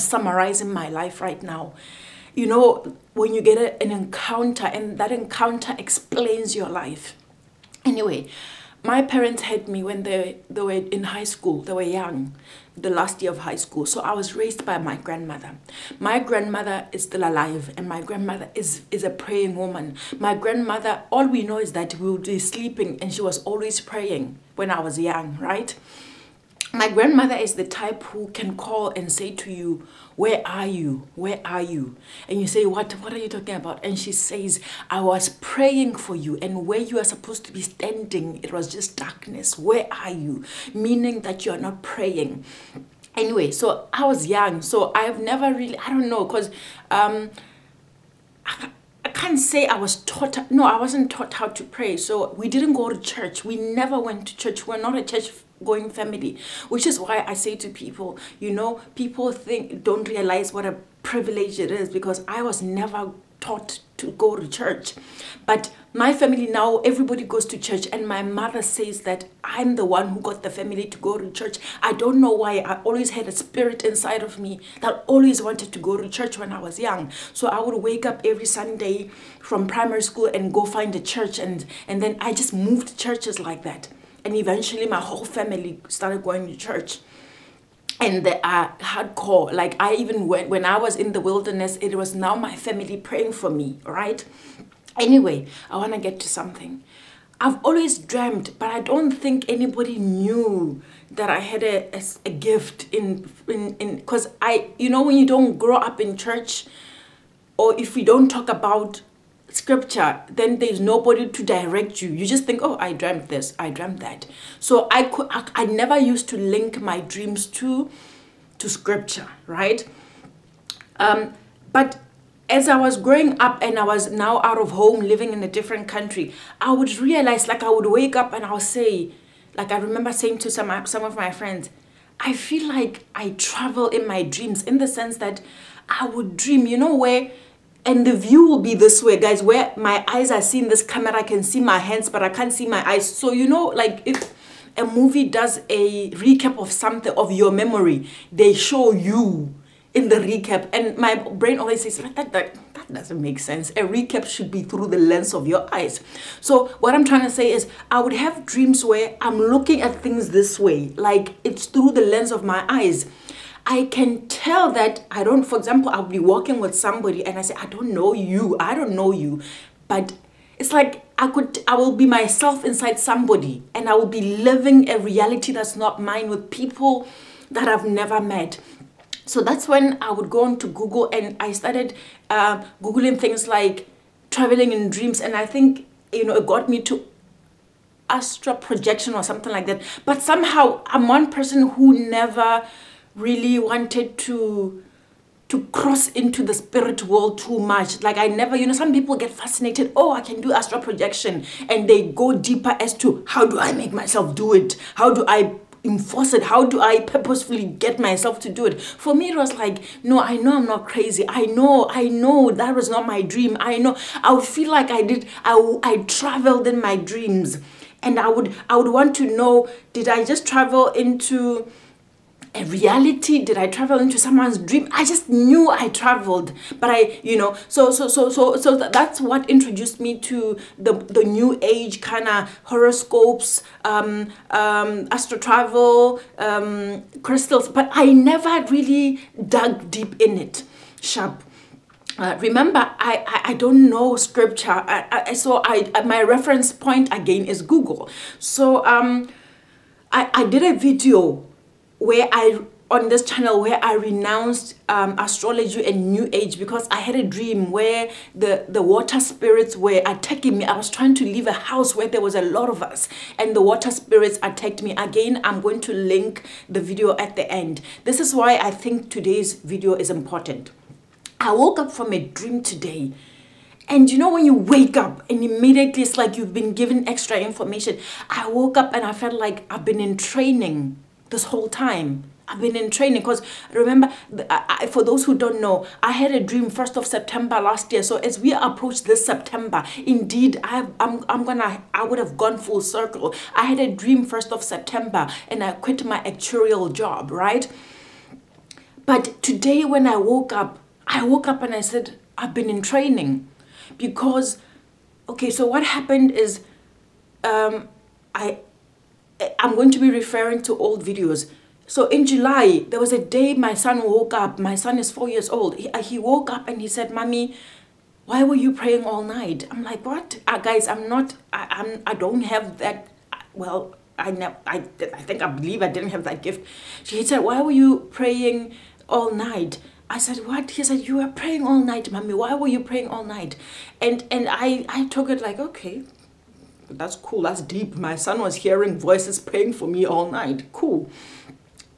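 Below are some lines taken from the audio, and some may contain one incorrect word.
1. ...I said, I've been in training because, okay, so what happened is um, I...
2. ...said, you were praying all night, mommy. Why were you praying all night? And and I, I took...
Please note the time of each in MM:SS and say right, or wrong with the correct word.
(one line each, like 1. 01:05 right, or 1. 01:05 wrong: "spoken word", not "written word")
1. 05:01 right
2. 05:30 right.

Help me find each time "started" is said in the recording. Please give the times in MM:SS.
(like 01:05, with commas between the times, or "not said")
01:25, 03:01.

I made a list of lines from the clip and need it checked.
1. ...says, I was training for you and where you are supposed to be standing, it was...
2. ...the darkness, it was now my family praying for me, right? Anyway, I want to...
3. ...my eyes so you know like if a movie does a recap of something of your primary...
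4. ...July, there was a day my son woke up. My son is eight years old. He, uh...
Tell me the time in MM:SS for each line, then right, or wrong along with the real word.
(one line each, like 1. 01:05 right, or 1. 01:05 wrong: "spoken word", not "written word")
1. 00:34 wrong: "praying", not "training"
2. 01:31 wrong: "wilderness", not "darkness"
3. 02:22 wrong: "memory", not "primary"
4. 05:12 wrong: "four", not "eight".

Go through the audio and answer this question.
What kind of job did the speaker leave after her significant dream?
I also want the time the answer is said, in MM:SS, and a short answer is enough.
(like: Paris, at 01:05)
Actuarial job, at 04:56.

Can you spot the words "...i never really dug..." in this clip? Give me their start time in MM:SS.
03:57.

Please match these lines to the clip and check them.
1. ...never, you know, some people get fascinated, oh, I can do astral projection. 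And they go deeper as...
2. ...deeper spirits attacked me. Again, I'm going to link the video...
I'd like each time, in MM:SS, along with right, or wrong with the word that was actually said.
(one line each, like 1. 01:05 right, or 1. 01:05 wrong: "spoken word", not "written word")
1. 03:18 right
2. 04:23 wrong: "water", not "deeper".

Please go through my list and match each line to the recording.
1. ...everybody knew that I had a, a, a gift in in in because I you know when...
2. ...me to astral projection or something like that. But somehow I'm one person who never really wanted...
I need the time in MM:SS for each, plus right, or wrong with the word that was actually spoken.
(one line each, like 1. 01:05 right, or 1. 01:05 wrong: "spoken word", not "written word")
1. 01:39 wrong: "anybody", not "everybody"
2. 03:06 right.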